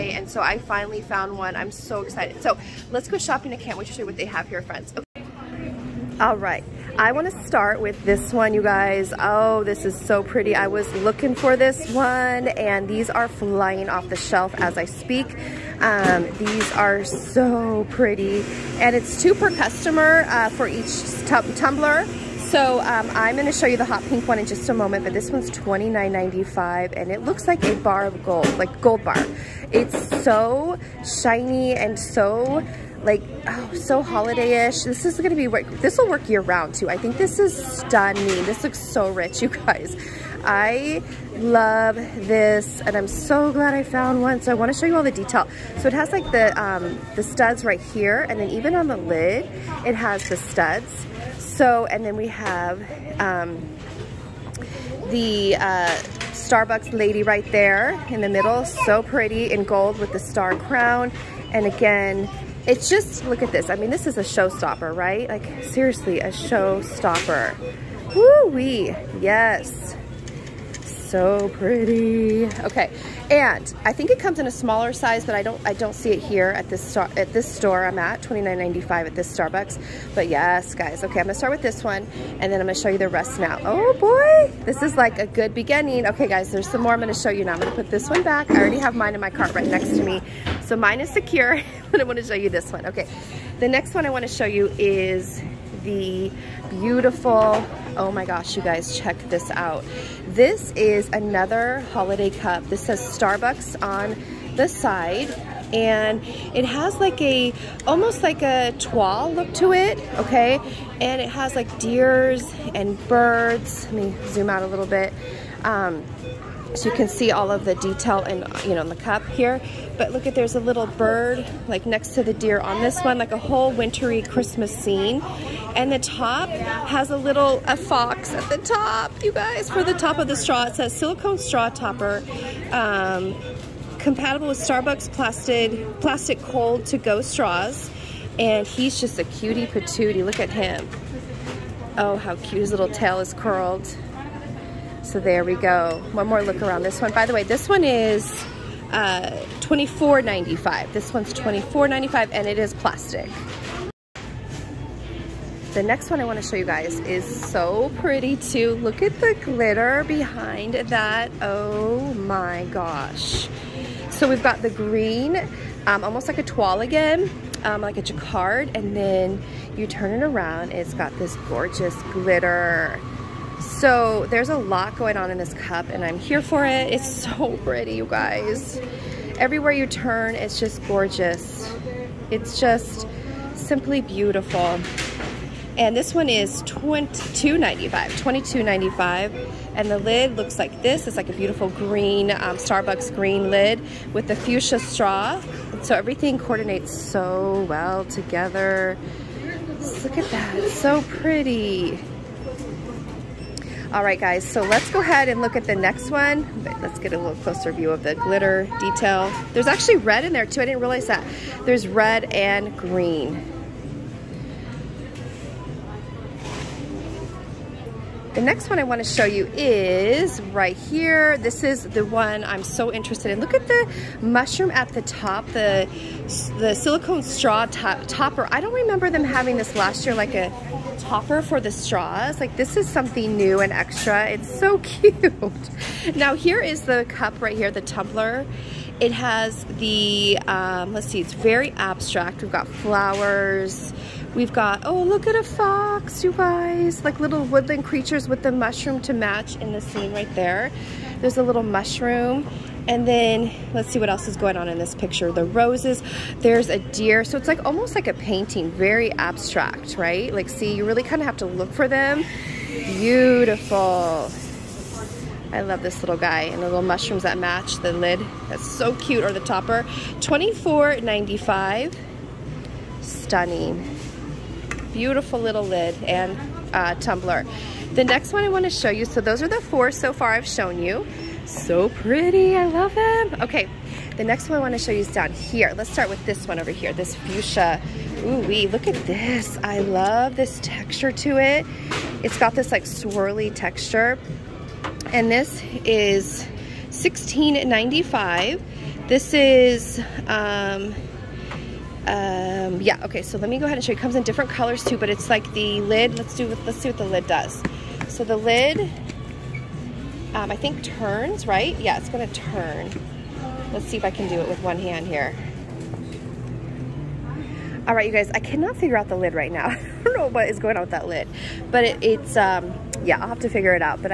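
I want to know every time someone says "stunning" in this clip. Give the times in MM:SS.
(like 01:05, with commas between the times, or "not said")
00:37, 04:32.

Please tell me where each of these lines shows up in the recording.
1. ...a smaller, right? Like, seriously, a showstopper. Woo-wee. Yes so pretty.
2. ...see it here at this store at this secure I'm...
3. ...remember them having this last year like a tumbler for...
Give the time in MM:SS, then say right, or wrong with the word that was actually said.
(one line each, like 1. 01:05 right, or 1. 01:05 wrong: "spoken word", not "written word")
1. 01:04 wrong: "showstopper", not "smaller"
2. 01:15 wrong: "store", not "secure"
3. 03:48 wrong: "topper", not "tumbler".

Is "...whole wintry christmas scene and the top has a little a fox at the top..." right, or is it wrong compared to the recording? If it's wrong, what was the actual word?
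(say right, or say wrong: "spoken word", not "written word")
right.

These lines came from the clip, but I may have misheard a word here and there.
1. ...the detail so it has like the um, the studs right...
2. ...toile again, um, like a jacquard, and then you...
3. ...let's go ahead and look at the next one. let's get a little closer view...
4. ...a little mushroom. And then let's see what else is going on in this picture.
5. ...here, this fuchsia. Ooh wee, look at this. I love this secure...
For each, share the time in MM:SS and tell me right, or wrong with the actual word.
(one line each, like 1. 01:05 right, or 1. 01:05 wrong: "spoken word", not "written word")
1. 00:45 right
2. 02:46 right
3. 03:24 right
4. 04:11 right
5. 04:46 wrong: "texture", not "secure".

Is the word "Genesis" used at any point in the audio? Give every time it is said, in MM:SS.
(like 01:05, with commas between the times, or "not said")
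not said.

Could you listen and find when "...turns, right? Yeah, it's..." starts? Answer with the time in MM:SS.
05:10.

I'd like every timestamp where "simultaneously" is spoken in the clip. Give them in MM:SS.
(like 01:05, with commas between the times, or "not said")
not said.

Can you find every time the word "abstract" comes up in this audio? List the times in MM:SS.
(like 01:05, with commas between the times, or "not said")
04:01, 04:19.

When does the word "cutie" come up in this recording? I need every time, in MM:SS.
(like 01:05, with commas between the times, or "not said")
02:19.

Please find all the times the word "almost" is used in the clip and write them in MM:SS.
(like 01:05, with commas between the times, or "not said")
01:47, 02:46, 04:17.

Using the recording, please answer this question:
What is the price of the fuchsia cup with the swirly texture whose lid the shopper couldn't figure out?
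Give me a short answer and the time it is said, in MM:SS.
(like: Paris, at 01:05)
$16.95, at 04:56.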